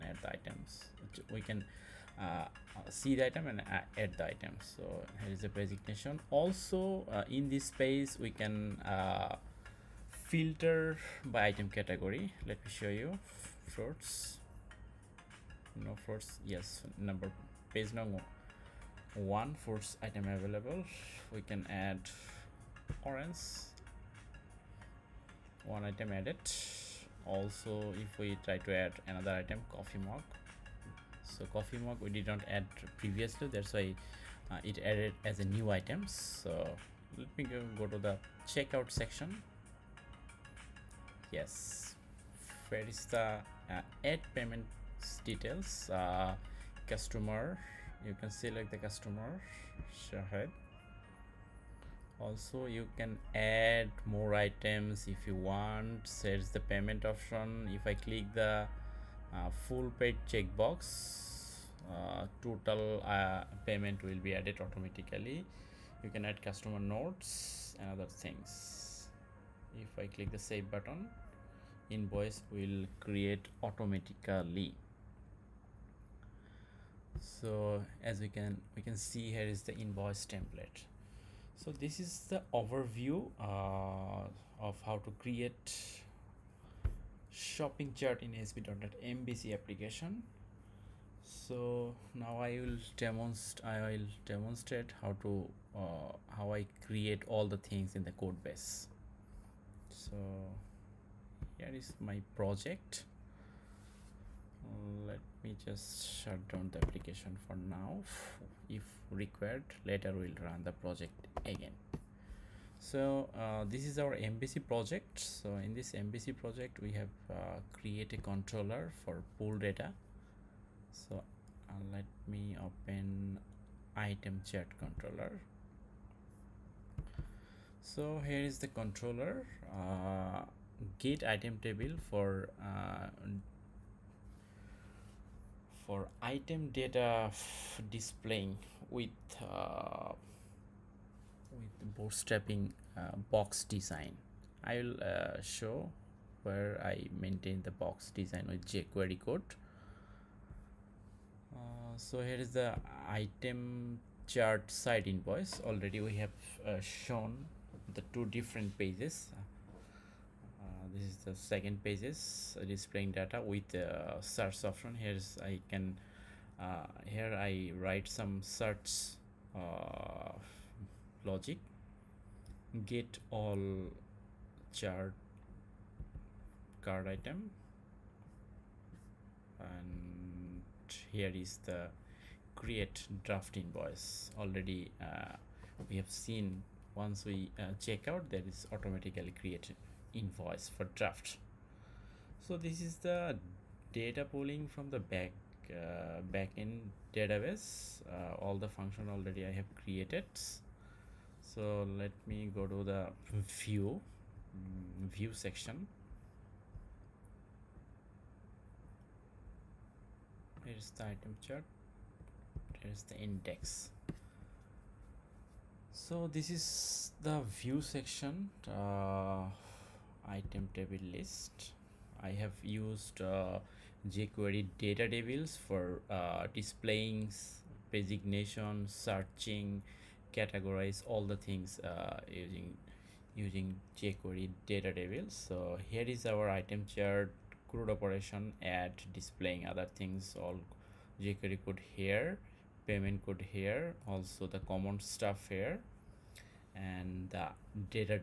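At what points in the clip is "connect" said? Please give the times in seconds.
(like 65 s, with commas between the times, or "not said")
not said.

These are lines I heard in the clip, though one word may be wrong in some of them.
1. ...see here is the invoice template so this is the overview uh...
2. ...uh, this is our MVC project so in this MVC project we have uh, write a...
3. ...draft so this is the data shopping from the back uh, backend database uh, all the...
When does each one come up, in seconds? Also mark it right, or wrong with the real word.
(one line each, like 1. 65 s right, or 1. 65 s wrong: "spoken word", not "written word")
1. 78 s right
2. 113 s wrong: "create", not "write"
3. 190 s wrong: "pulling", not "shopping".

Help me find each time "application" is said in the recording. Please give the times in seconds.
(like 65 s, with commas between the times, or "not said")
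89 s, 106 s.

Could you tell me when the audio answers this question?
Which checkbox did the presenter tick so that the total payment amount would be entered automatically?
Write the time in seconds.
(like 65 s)
59 s.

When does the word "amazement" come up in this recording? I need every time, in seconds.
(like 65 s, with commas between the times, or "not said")
not said.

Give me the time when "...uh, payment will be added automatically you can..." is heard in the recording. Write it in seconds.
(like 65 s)
63 s.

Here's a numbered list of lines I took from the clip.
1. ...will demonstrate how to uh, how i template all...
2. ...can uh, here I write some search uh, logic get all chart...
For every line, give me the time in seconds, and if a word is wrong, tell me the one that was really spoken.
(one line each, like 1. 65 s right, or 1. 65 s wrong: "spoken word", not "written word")
1. 93 s wrong: "create", not "template"
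2. 165 s right.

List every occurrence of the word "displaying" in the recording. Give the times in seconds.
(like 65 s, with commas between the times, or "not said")
137 s, 162 s, 226 s, 239 s.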